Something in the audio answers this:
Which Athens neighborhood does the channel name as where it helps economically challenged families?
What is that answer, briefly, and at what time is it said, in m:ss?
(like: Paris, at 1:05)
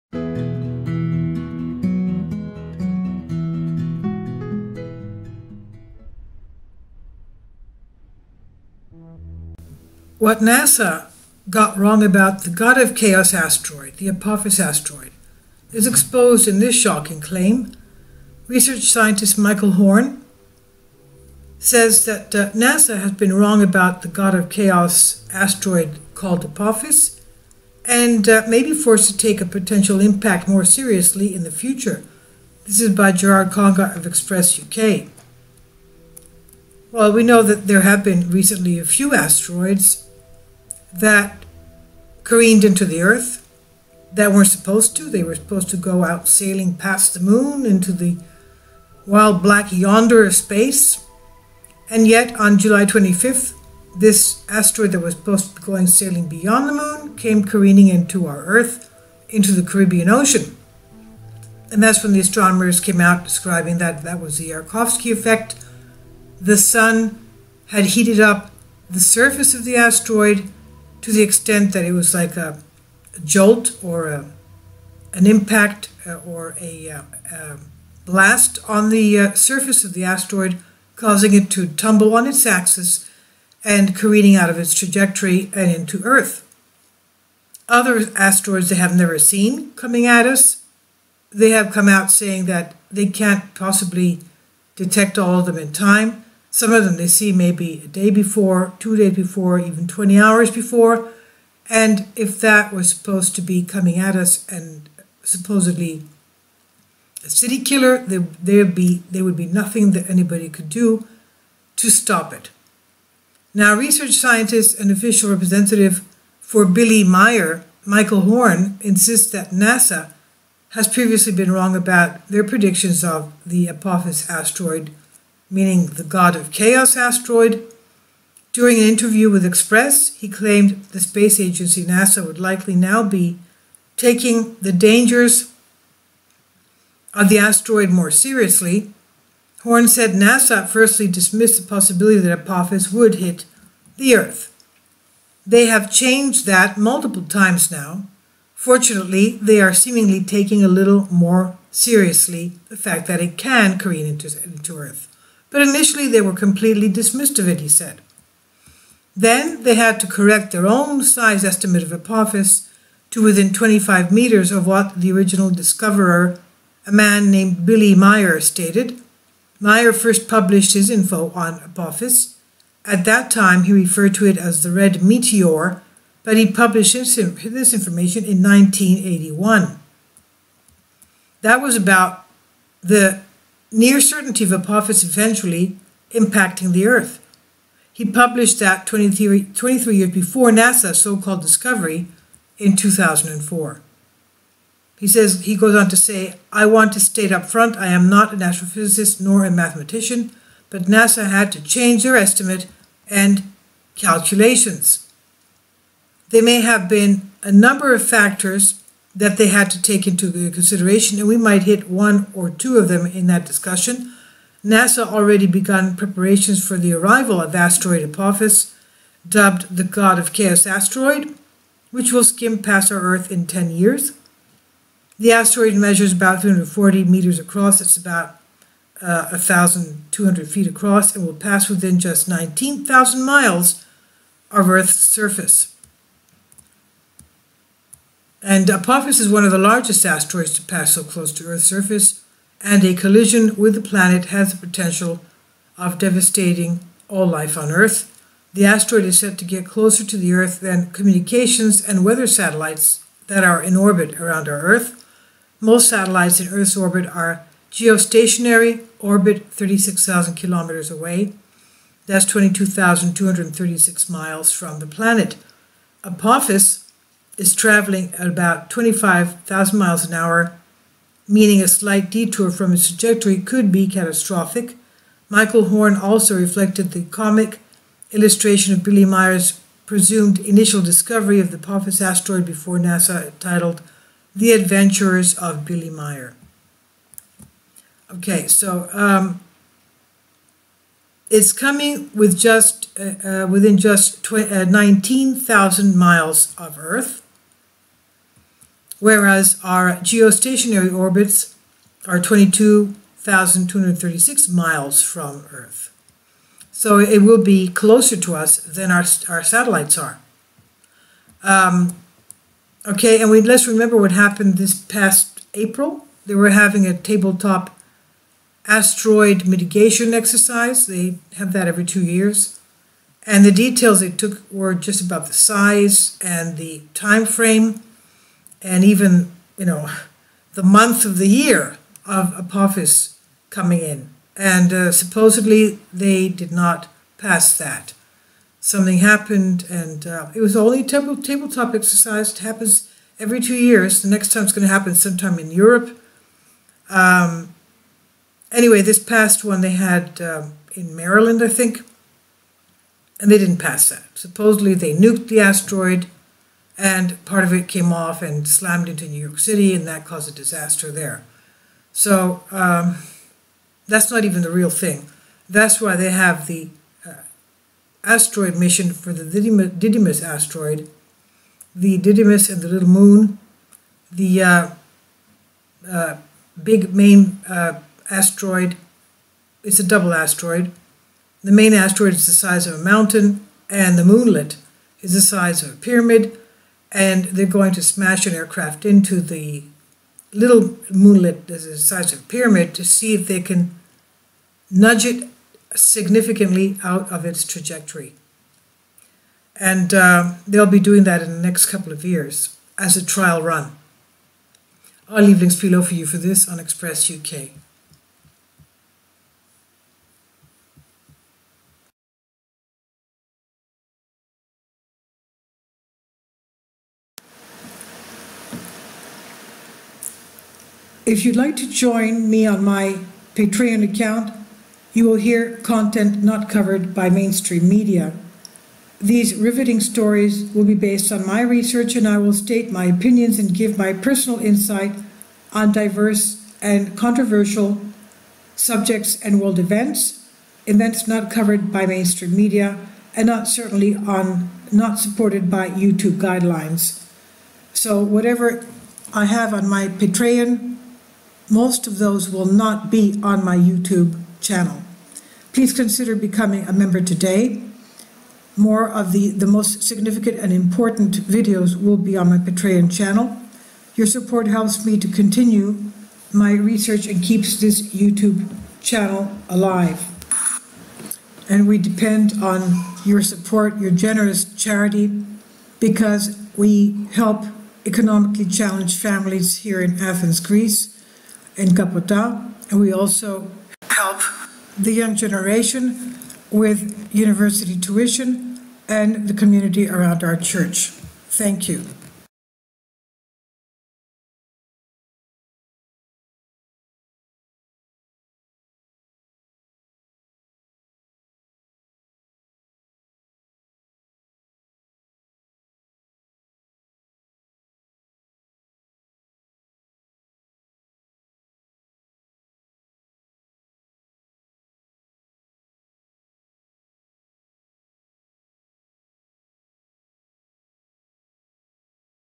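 Capota, at 8:01.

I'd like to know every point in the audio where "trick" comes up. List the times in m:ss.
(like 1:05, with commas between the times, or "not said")
not said.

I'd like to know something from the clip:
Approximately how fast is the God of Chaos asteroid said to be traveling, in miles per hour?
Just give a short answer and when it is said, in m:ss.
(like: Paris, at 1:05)
25,000 miles an hour, at 4:28.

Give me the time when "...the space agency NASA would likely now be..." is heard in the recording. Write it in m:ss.
2:10.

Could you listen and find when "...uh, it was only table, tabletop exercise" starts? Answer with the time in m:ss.
5:40.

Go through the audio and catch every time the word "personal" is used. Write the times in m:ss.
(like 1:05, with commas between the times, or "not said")
7:13.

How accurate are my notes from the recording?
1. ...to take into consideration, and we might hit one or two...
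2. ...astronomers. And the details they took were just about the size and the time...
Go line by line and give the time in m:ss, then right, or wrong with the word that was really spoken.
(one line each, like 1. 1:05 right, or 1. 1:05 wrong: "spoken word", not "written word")
1. 3:29 right
2. 5:22 wrong: "years", not "astronomers".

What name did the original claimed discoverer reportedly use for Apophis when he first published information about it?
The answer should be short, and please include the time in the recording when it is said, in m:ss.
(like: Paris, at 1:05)
Red Meteor, at 2:54.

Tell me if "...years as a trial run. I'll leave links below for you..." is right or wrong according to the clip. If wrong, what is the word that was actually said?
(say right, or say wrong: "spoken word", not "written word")
right.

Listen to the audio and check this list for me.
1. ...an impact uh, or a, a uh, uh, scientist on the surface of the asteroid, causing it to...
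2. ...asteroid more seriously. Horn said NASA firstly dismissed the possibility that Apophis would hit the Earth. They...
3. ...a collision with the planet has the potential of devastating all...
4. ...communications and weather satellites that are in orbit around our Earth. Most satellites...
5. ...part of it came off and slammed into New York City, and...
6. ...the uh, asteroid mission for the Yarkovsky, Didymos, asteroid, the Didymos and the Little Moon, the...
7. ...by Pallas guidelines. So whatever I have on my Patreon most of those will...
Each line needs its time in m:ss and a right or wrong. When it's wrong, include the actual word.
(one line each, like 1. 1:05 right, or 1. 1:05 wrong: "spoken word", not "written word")
1. 1:15 wrong: "blast", not "scientist"
2. 2:17 right
3. 4:02 right
4. 4:10 right
5. 5:57 right
6. 6:06 wrong: "Didymos", not "Yarkovsky"
7. 7:25 wrong: "YouTube", not "Pallas".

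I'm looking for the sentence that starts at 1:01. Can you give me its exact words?
And that's when the astronomers came out describing that that was the Yarkovsky effect.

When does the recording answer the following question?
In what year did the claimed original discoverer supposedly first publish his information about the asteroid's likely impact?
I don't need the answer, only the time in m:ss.
2:58.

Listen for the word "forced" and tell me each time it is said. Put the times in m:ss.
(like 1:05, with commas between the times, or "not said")
0:28.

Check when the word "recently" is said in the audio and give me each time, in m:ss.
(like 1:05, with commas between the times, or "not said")
0:38.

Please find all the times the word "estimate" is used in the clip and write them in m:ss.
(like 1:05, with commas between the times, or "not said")
2:41, 3:22.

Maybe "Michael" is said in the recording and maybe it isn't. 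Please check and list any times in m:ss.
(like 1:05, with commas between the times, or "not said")
0:19, 1:57, 4:35.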